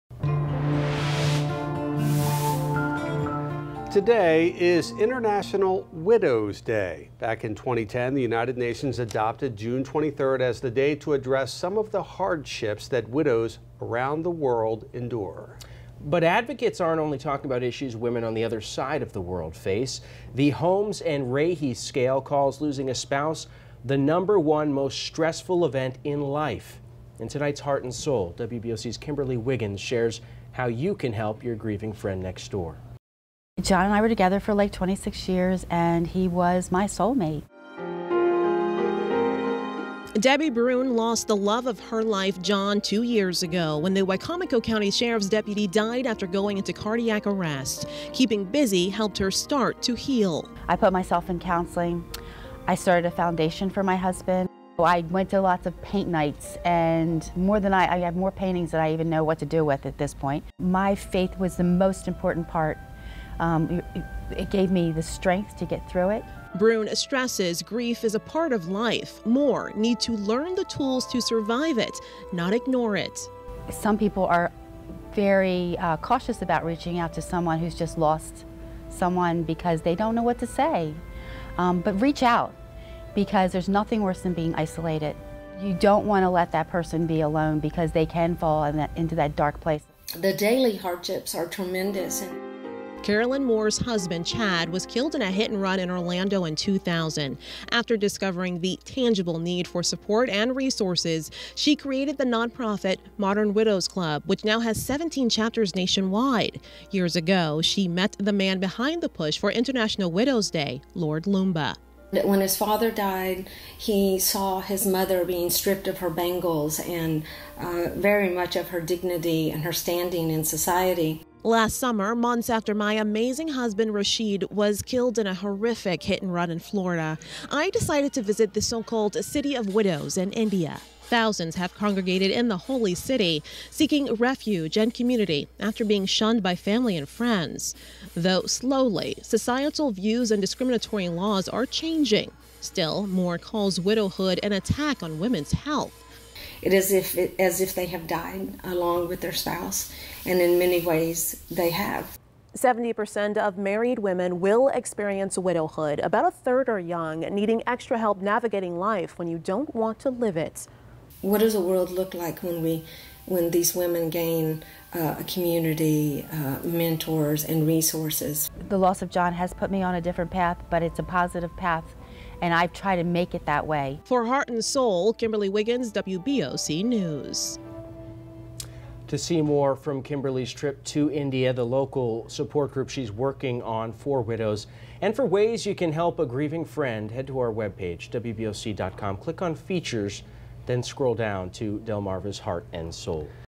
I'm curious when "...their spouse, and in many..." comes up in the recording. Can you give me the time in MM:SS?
02:29.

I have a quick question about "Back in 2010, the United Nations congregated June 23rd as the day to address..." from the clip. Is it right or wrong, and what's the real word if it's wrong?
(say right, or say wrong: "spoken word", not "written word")
wrong: "adopted", not "congregated".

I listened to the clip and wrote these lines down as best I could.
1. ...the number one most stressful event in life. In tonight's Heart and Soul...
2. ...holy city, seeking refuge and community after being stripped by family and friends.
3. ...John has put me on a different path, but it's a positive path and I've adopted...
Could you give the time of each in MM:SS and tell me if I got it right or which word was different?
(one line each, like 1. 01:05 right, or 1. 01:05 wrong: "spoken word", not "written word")
1. 00:23 right
2. 02:12 wrong: "shunned", not "stripped"
3. 02:49 wrong: "tried", not "adopted".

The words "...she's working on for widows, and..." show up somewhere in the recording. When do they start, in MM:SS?
03:02.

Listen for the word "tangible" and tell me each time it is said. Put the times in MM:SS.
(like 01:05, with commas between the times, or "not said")
01:38.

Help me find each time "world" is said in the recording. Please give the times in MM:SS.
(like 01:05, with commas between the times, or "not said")
00:14, 00:19, 02:41.